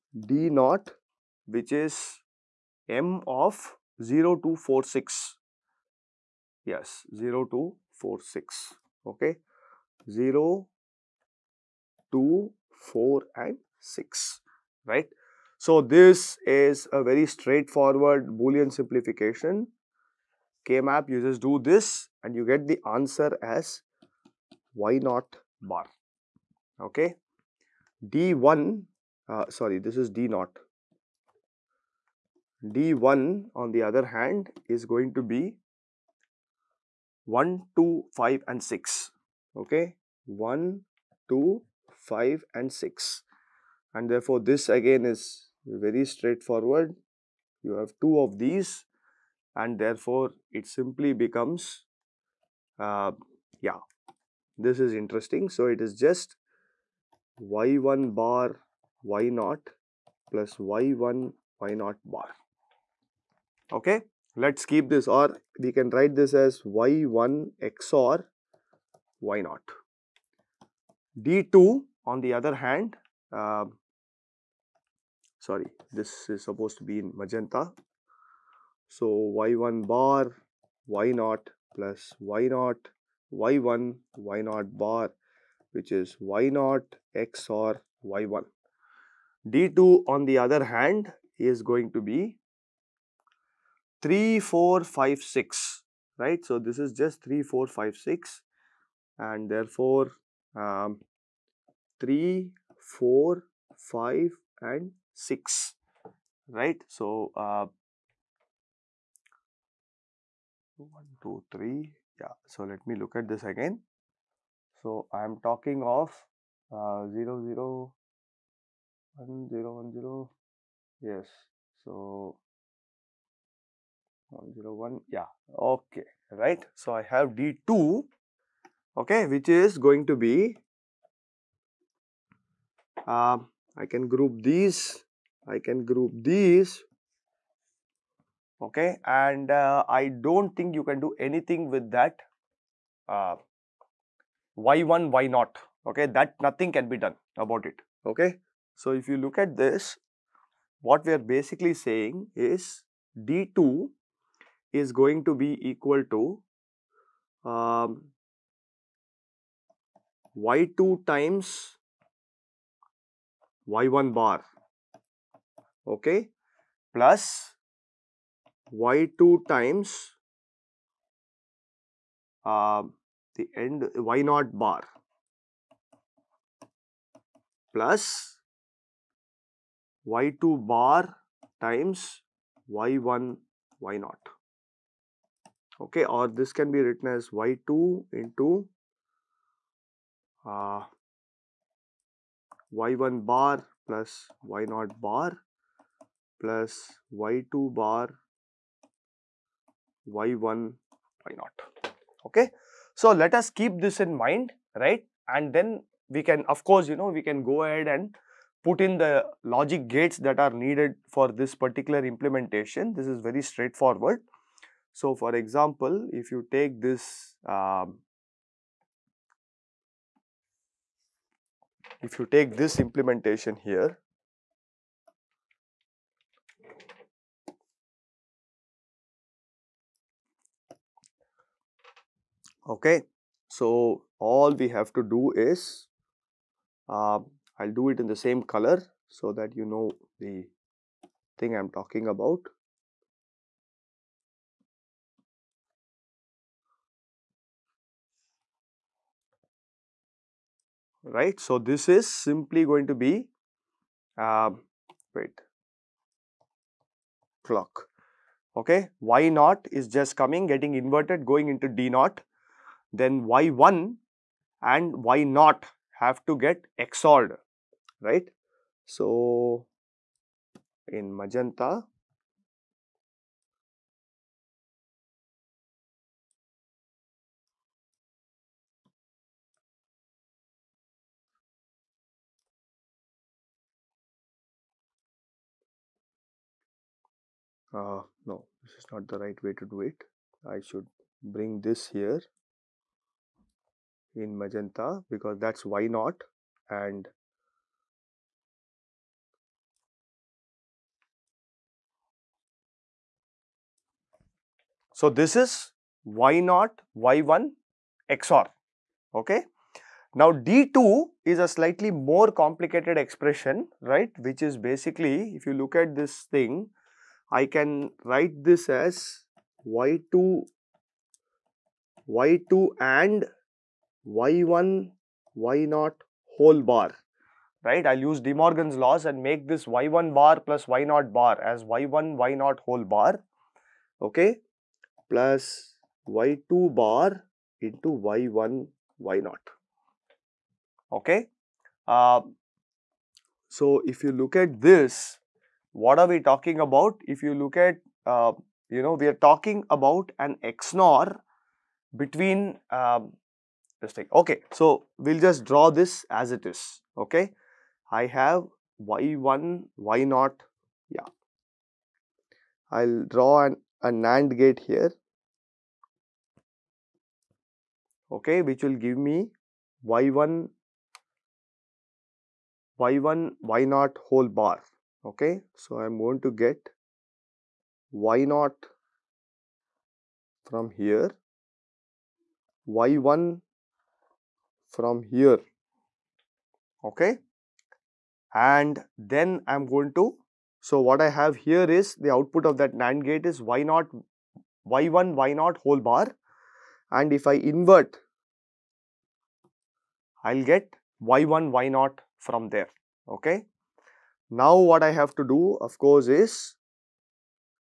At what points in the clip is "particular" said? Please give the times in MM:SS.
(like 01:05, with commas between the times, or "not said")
03:31.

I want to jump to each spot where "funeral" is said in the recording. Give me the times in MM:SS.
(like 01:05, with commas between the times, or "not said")
not said.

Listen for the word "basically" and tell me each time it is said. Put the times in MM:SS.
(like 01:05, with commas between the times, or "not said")
02:31, 05:14.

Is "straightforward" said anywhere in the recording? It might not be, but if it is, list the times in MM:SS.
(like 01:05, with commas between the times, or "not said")
00:17, 00:46, 03:33.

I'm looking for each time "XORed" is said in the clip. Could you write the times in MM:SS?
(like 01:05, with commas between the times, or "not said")
04:26.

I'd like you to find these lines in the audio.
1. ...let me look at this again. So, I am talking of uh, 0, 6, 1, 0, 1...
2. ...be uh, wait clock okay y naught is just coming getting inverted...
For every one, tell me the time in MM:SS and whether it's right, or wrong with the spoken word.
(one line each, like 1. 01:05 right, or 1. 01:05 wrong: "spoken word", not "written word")
1. 01:52 wrong: "0", not "6"
2. 04:12 right.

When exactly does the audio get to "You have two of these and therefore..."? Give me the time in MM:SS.
00:47.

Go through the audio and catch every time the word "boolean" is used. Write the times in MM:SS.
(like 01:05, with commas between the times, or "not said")
00:18.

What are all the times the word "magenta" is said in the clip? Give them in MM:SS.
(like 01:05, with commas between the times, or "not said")
01:17, 04:31, 04:54.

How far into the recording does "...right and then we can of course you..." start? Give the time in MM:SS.
03:24.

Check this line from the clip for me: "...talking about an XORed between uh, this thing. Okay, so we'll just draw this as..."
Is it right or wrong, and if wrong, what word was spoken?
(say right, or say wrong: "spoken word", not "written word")
wrong: "XNOR", not "XORed".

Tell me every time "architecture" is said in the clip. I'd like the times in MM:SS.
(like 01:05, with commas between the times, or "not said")
not said.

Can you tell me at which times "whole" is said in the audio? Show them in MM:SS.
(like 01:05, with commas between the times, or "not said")
05:26, 05:32, 06:14, 06:35.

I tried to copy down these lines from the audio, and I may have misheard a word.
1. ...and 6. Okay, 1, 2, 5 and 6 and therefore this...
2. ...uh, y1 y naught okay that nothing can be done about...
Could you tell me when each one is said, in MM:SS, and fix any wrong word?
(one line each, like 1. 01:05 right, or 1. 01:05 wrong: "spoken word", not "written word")
1. 00:38 right
2. 02:23 right.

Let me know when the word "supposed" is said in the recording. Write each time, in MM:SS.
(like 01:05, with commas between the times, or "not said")
01:16.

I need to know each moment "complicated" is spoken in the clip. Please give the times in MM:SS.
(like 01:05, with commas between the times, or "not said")
05:12.